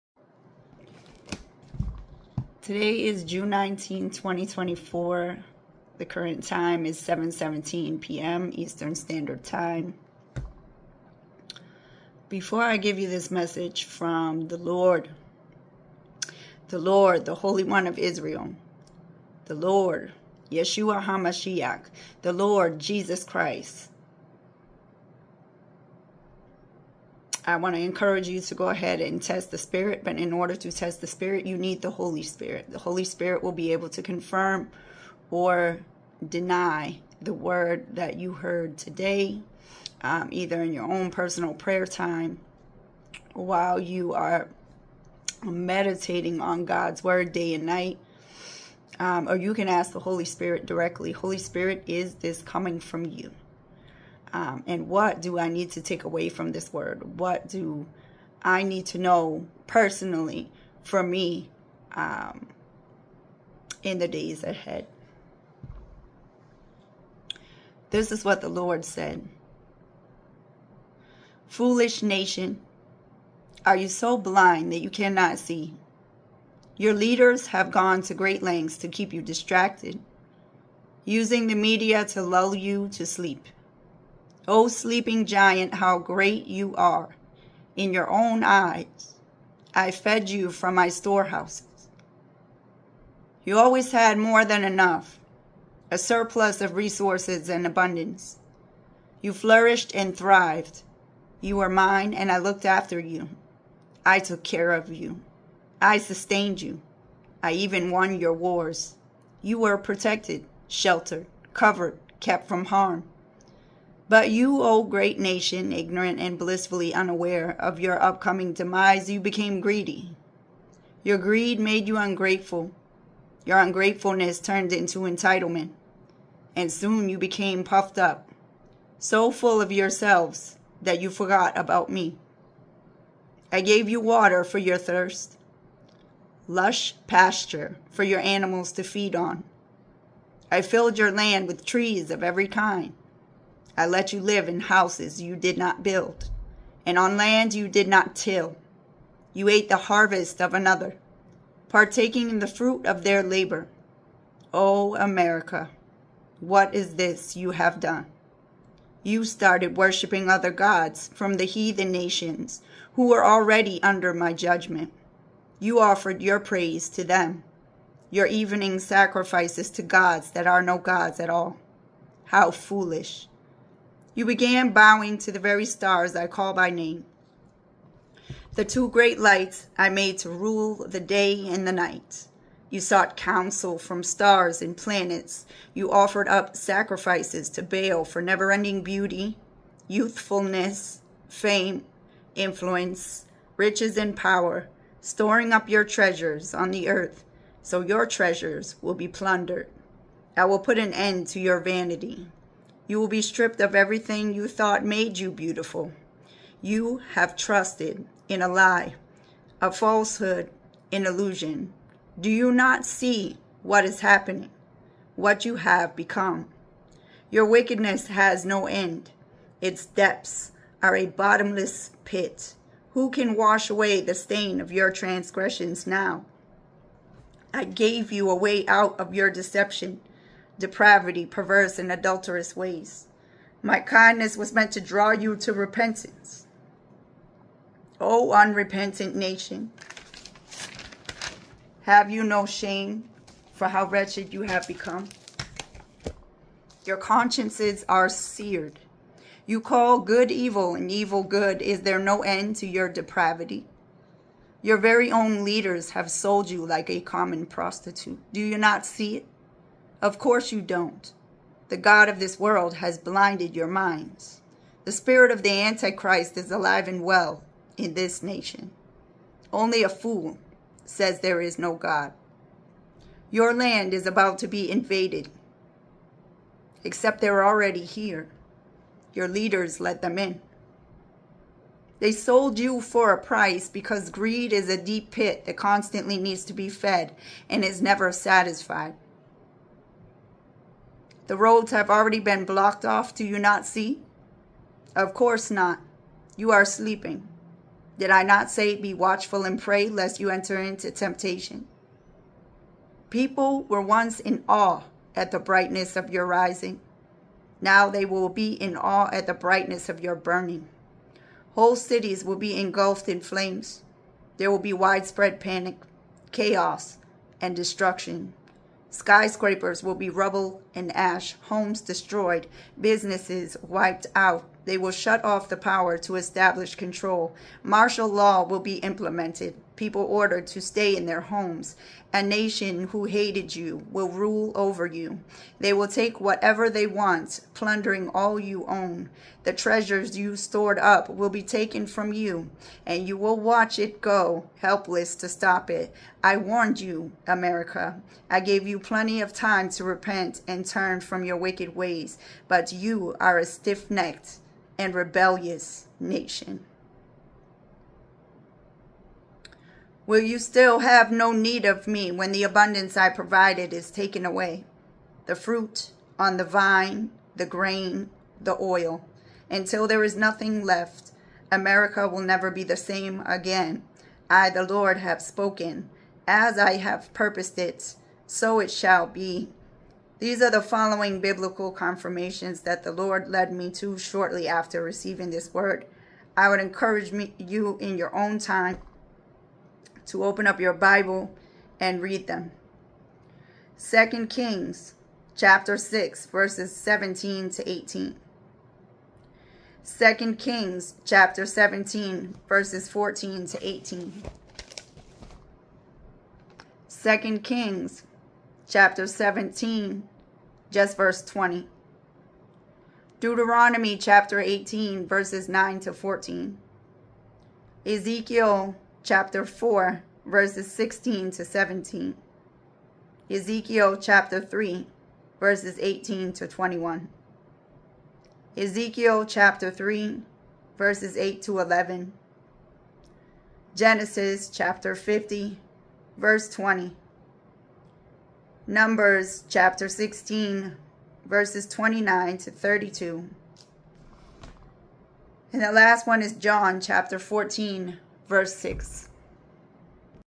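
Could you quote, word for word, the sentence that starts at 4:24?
The spirit of the Antichrist is alive and well in this nation.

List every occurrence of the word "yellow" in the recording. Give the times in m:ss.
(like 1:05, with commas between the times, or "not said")
not said.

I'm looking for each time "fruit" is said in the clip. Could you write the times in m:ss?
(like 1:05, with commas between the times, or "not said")
2:32, 6:05.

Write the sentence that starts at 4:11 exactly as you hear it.
Is there no end to your depravity?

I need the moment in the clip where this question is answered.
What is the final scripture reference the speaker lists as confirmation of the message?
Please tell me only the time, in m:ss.
7:26.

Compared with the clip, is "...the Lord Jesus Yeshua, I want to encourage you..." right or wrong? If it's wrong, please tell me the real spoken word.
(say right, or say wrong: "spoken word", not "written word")
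wrong: "Christ", not "Yeshua".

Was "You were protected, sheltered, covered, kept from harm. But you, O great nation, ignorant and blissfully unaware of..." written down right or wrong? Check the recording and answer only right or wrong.
right.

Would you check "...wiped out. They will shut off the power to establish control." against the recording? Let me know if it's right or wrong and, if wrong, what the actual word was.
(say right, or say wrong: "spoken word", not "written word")
right.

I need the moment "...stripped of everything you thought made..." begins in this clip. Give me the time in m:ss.
3:23.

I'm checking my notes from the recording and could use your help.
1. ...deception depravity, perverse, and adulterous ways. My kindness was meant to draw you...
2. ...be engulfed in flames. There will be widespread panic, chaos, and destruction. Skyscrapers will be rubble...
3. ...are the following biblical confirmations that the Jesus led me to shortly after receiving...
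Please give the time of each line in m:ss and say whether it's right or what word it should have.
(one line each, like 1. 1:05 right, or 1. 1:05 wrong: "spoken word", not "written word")
1. 3:49 right
2. 5:12 right
3. 6:20 wrong: "Lord", not "Jesus".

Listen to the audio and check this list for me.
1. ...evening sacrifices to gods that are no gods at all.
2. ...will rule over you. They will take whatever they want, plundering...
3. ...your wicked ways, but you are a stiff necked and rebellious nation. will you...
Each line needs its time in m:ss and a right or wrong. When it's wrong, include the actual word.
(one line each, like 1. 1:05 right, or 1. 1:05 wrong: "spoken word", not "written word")
1. 2:48 right
2. 5:33 right
3. 5:51 right.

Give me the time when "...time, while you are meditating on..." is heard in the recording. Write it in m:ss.
0:41.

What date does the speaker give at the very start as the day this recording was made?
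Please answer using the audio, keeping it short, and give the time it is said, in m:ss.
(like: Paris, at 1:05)
June 19, 2024, at 0:03.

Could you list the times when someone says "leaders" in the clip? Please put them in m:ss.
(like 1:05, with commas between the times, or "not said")
1:16, 4:15, 4:39.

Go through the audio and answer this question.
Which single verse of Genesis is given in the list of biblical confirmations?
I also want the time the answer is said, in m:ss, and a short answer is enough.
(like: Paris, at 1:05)
Genesis 50:20, at 7:13.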